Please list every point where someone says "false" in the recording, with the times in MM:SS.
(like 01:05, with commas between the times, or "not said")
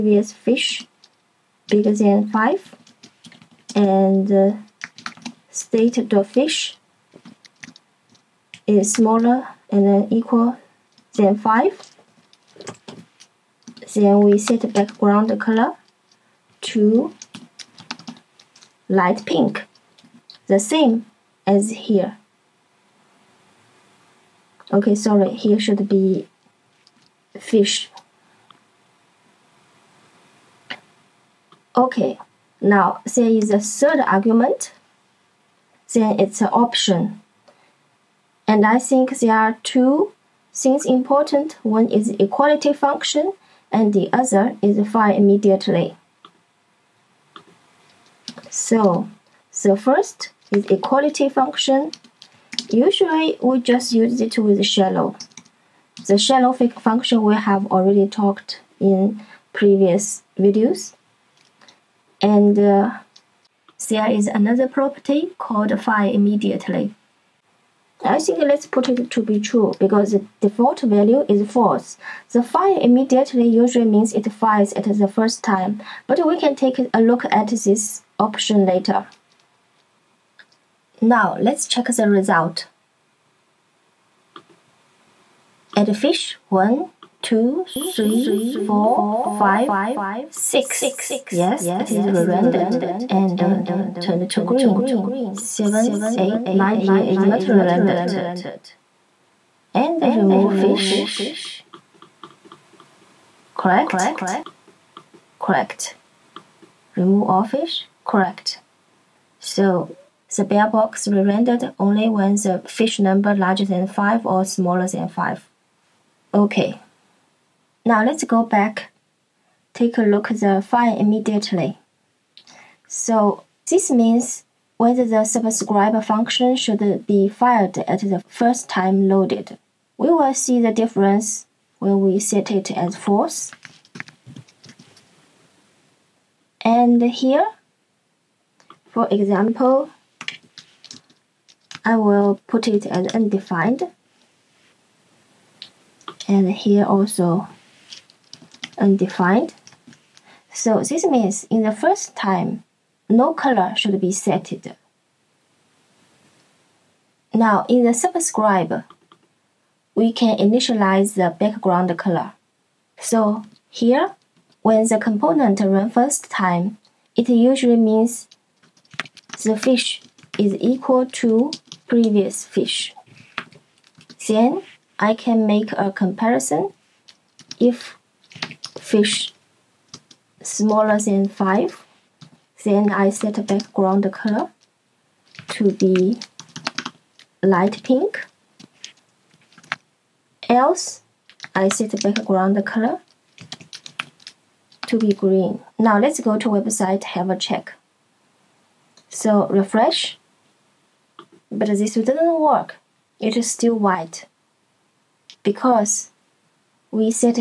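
01:11, 02:12.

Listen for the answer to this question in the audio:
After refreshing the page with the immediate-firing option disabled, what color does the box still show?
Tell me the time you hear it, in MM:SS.
03:23.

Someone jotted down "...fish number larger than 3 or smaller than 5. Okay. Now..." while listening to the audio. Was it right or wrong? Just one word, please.
wrong.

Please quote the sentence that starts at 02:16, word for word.
And here, for example, I will put it as undefined.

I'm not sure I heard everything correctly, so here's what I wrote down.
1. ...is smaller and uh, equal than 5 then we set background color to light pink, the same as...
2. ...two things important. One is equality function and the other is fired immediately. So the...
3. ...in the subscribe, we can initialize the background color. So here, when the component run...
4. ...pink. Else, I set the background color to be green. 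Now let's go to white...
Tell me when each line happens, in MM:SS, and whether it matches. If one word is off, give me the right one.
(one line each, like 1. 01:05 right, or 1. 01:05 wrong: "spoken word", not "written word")
1. 00:08 right
2. 00:39 right
3. 02:37 right
4. 03:07 wrong: "website", not "white".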